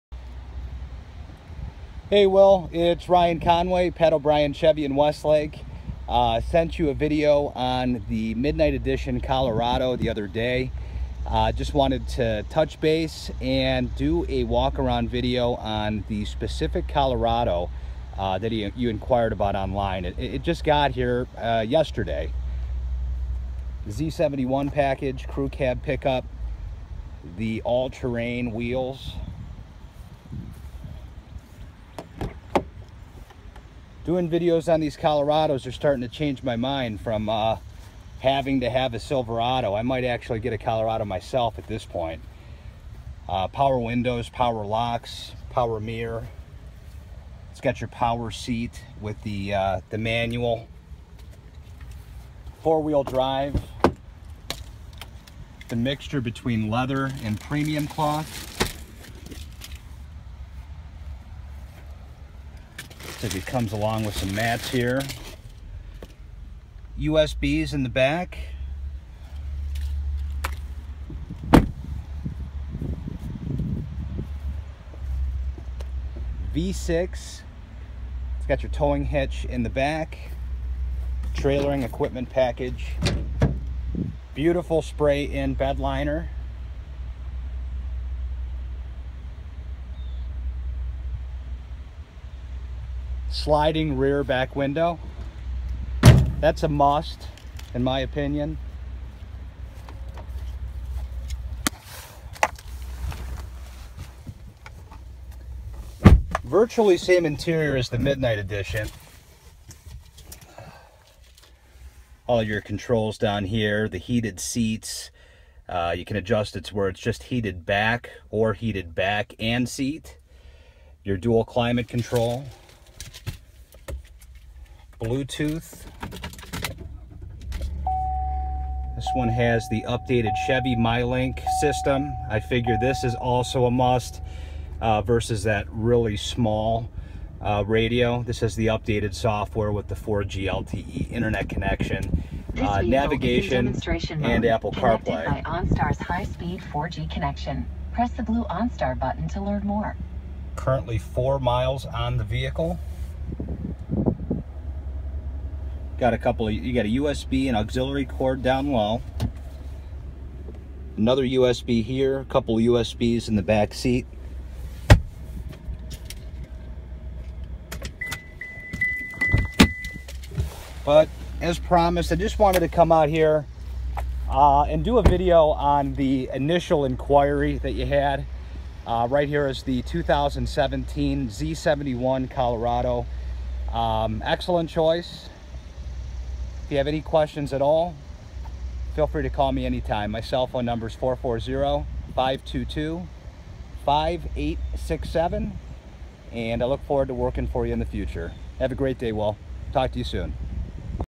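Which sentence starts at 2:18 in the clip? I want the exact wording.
This is the updated software with the 4G LTE internet connection, uh, navigation, and Apple CarPlay.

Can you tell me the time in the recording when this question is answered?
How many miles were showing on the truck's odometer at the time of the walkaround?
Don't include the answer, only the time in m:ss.
2:30.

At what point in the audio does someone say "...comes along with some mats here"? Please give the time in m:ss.
1:03.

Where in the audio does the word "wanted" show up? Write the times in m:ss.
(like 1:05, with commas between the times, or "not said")
0:11, 2:52.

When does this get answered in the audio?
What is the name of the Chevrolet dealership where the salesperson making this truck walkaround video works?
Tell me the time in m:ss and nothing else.
0:03.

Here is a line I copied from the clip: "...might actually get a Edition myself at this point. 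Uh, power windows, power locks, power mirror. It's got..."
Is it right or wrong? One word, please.
wrong.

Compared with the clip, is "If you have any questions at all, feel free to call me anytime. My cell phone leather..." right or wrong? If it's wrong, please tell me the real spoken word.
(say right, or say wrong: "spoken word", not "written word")
wrong: "number", not "leather".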